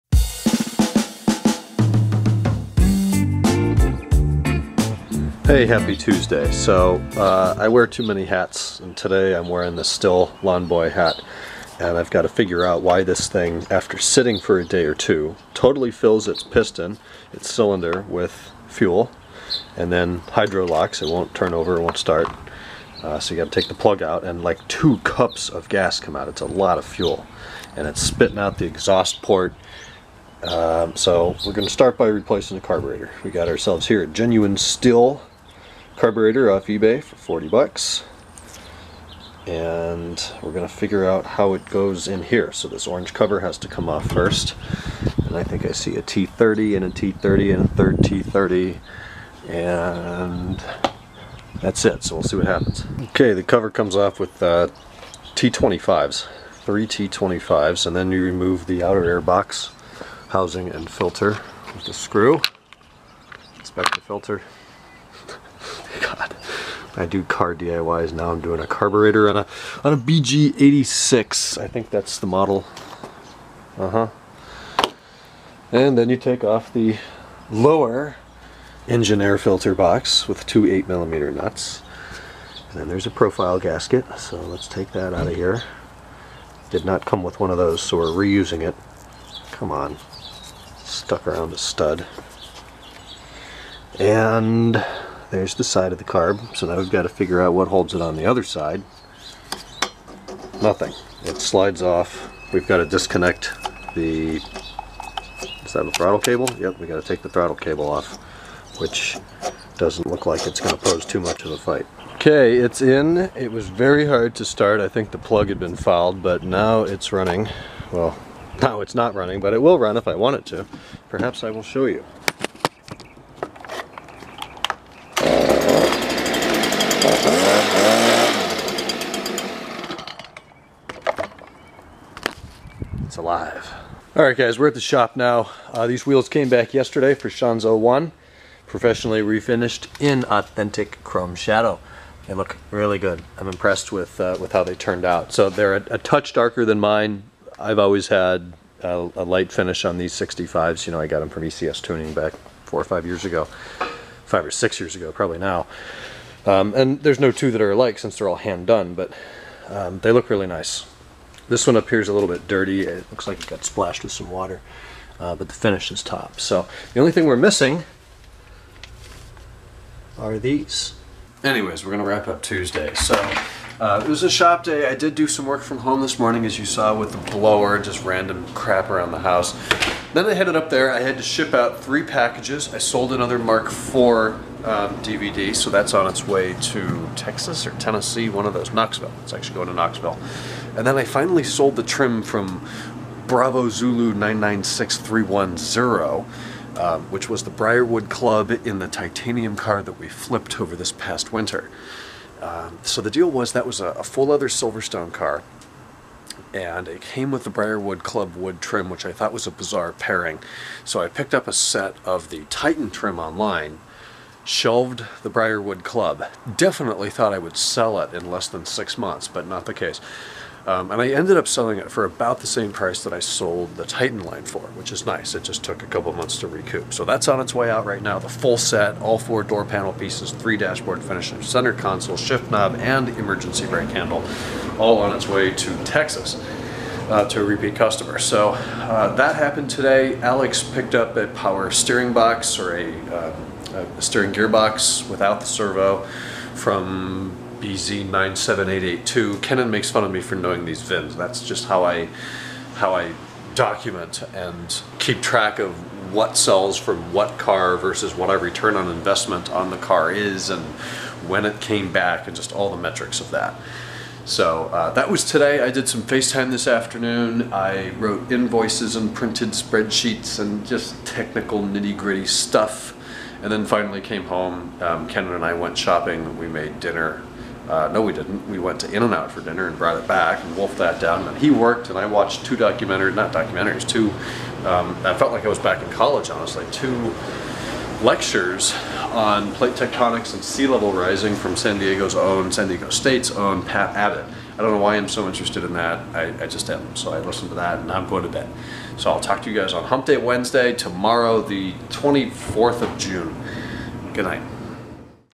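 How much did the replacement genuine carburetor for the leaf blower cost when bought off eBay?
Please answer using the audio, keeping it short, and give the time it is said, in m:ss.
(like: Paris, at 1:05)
$40, at 0:37.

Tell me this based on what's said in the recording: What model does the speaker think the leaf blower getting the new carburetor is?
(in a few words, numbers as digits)
BG86.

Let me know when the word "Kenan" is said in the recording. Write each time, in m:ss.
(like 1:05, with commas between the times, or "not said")
4:09, 4:35.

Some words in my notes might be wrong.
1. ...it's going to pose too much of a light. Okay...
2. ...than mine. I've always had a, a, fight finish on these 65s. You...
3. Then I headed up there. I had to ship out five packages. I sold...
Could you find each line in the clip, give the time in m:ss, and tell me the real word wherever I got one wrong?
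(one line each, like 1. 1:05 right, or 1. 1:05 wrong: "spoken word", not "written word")
1. 1:50 wrong: "fight", not "light"
2. 2:26 wrong: "light", not "fight"
3. 3:00 wrong: "three", not "five".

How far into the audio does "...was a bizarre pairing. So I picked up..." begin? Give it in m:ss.
3:29.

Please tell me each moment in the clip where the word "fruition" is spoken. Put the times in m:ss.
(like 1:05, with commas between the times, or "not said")
not said.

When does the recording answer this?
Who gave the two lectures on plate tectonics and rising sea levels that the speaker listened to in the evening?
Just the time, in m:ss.
4:53.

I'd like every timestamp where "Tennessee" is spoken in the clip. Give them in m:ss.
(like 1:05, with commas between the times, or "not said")
3:07.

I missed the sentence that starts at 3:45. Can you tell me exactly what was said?
It just took a couple months to recoup.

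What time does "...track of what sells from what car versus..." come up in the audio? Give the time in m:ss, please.
4:15.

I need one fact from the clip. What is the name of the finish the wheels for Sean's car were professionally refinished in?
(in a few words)
chrome shadow.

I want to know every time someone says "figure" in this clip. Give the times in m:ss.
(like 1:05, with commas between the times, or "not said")
0:12, 0:40, 1:37.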